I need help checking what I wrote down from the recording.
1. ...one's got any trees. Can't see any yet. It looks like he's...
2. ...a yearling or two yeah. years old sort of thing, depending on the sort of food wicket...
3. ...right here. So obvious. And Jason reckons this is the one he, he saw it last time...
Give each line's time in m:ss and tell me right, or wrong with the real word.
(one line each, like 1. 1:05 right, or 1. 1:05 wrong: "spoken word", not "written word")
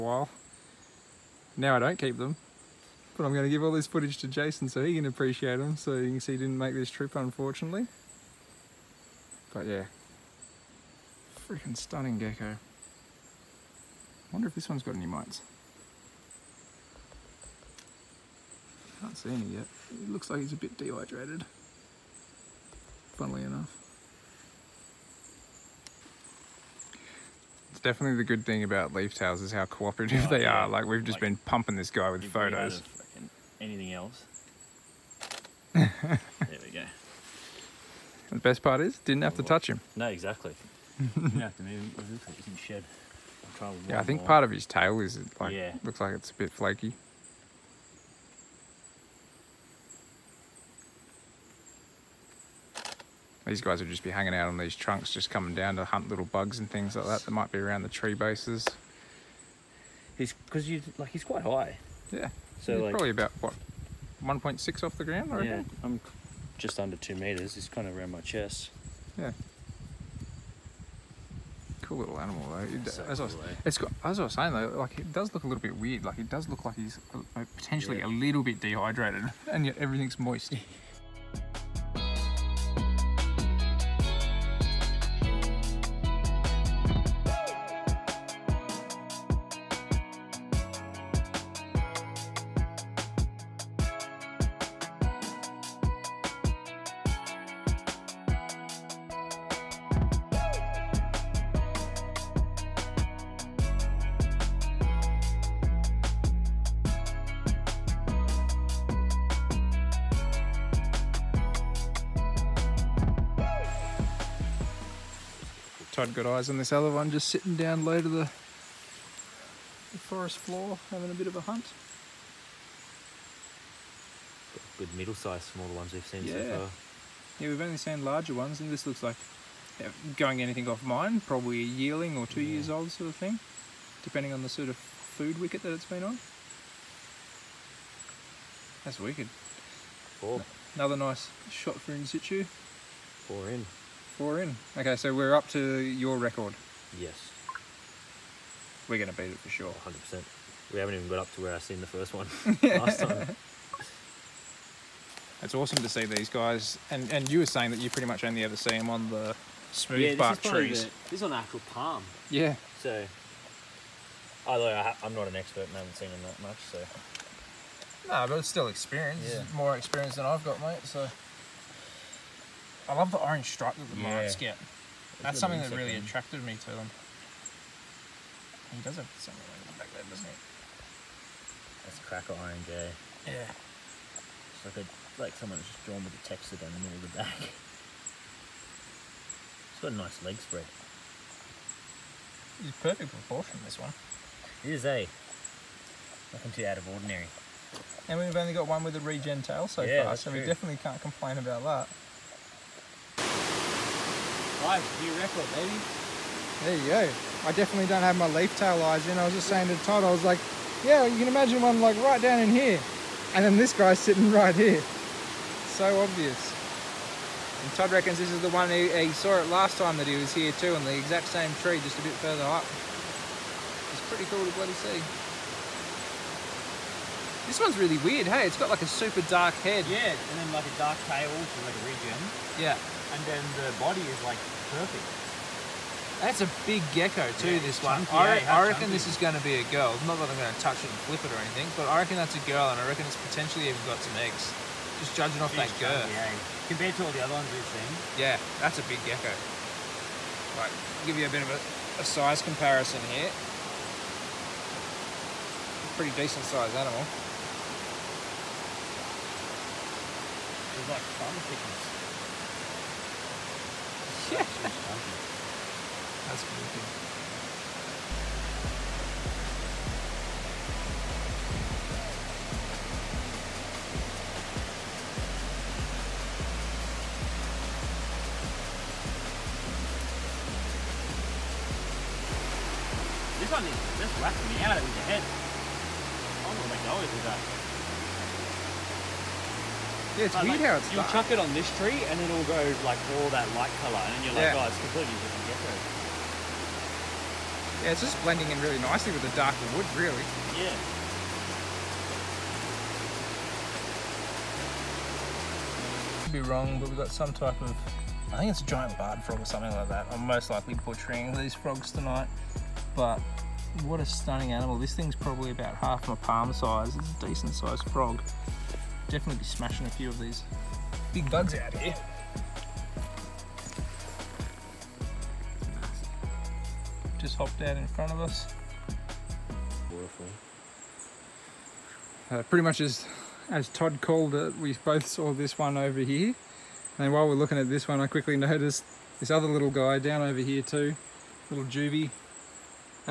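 1. 0:14 wrong: "mites", not "trees"
2. 2:11 right
3. 3:34 wrong: "Todd", not "Jason".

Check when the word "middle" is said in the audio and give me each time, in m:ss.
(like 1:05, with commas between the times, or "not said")
2:04, 3:06.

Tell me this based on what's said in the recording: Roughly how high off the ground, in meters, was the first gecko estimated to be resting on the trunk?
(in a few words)
1.6.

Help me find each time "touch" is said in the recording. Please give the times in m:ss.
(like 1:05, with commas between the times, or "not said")
0:39, 4:00.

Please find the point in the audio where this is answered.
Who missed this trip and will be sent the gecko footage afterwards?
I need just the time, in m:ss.
0:04.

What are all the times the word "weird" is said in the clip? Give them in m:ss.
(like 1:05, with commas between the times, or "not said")
1:15, 3:48, 4:50.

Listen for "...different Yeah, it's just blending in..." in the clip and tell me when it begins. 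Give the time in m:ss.
4:55.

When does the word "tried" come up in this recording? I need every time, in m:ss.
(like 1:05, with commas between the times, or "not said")
1:56.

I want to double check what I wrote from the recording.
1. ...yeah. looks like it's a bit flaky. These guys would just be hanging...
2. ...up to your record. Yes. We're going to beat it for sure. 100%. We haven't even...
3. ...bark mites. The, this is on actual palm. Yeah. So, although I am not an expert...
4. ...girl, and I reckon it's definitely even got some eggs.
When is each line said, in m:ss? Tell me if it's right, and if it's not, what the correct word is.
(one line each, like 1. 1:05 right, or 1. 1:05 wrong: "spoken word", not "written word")
1. 0:45 right
2. 2:25 right
3. 2:40 wrong: "trees", not "mites"
4. 4:02 wrong: "potentially", not "definitely".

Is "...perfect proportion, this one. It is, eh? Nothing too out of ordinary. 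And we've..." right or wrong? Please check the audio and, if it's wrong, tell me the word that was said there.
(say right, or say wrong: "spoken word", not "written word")
right.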